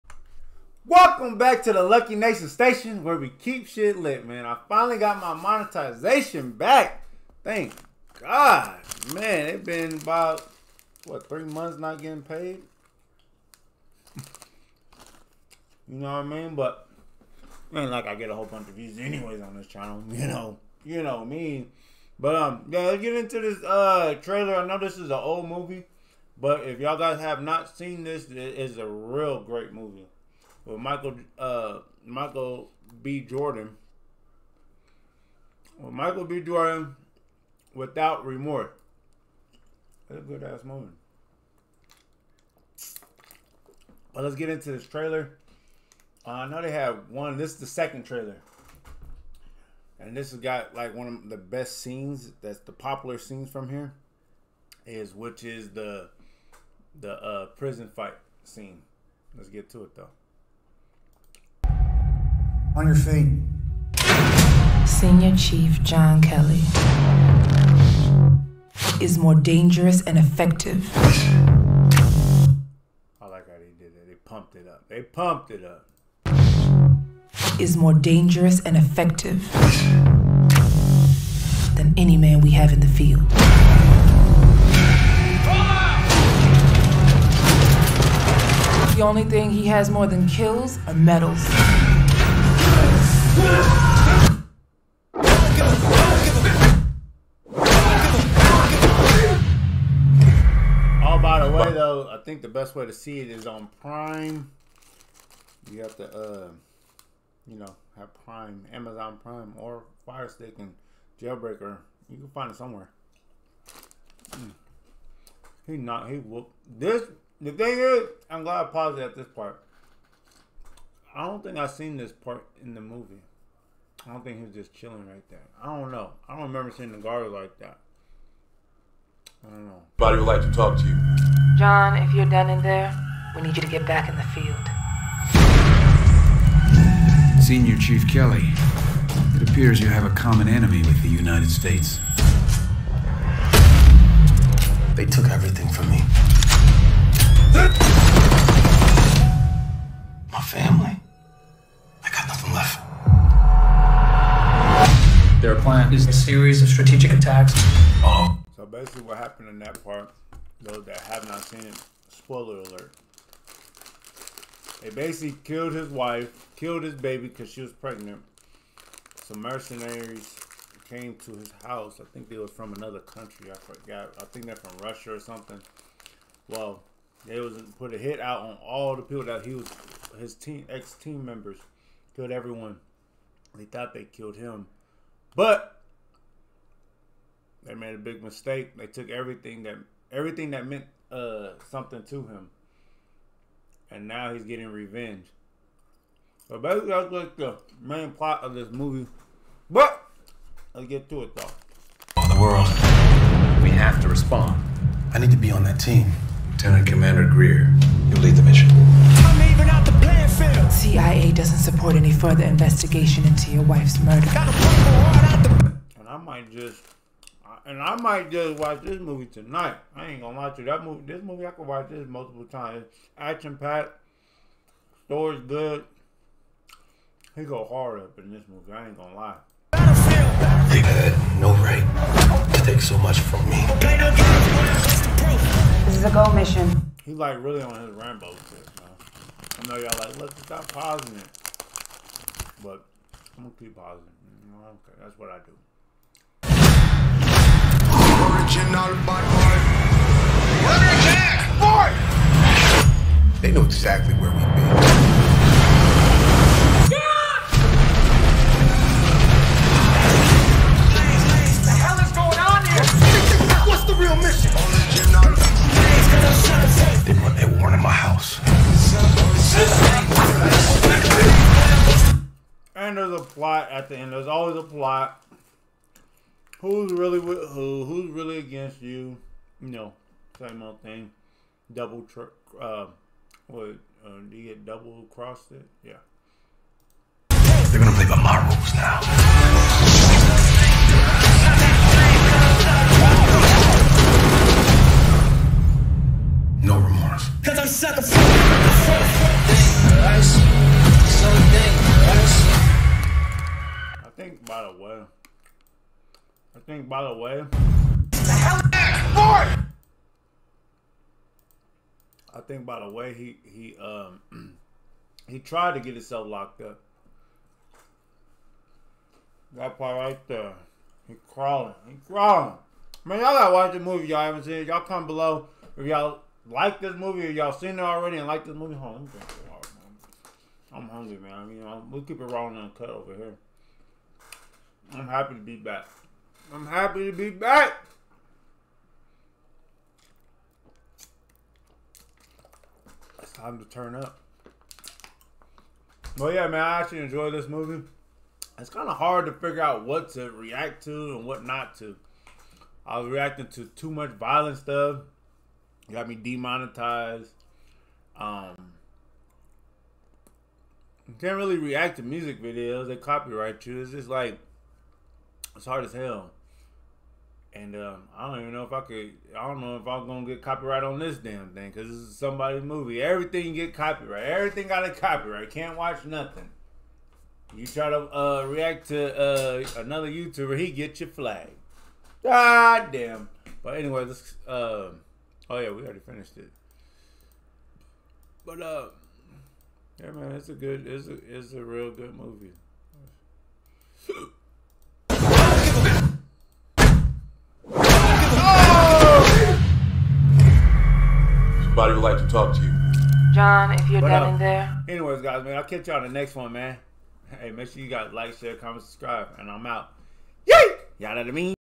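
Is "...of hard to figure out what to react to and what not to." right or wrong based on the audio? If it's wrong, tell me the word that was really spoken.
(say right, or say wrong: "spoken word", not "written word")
right.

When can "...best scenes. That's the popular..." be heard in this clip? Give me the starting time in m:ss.
0:51.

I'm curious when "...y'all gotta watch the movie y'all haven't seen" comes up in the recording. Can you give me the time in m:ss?
5:23.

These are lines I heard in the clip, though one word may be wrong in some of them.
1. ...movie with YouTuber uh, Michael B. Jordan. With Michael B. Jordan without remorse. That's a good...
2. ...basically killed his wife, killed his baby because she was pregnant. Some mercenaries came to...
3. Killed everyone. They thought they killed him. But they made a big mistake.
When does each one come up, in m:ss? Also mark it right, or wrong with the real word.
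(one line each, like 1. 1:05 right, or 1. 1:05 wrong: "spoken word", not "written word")
1. 0:29 wrong: "Michael", not "YouTuber"
2. 2:44 right
3. 3:02 right.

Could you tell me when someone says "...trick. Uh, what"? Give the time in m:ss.
4:42.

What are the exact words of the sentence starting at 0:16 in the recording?
But ain't like I get a whole bunch of views anyways on this channel.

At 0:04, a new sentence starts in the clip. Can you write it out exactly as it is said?
I finally got my monetization back.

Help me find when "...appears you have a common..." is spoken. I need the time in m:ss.
2:19.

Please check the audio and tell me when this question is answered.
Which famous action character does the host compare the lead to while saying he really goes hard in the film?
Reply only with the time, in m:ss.
3:57.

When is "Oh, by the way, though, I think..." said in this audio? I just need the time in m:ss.
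1:41.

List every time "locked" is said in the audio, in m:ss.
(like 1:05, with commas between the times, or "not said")
5:16.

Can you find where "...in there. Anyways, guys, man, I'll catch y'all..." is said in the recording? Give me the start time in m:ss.
6:44.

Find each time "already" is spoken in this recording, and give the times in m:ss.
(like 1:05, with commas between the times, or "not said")
5:27, 6:25.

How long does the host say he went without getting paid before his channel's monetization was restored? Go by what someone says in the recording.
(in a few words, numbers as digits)
3 months.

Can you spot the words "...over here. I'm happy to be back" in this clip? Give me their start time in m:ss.
5:32.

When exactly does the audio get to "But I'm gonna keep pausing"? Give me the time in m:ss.
4:02.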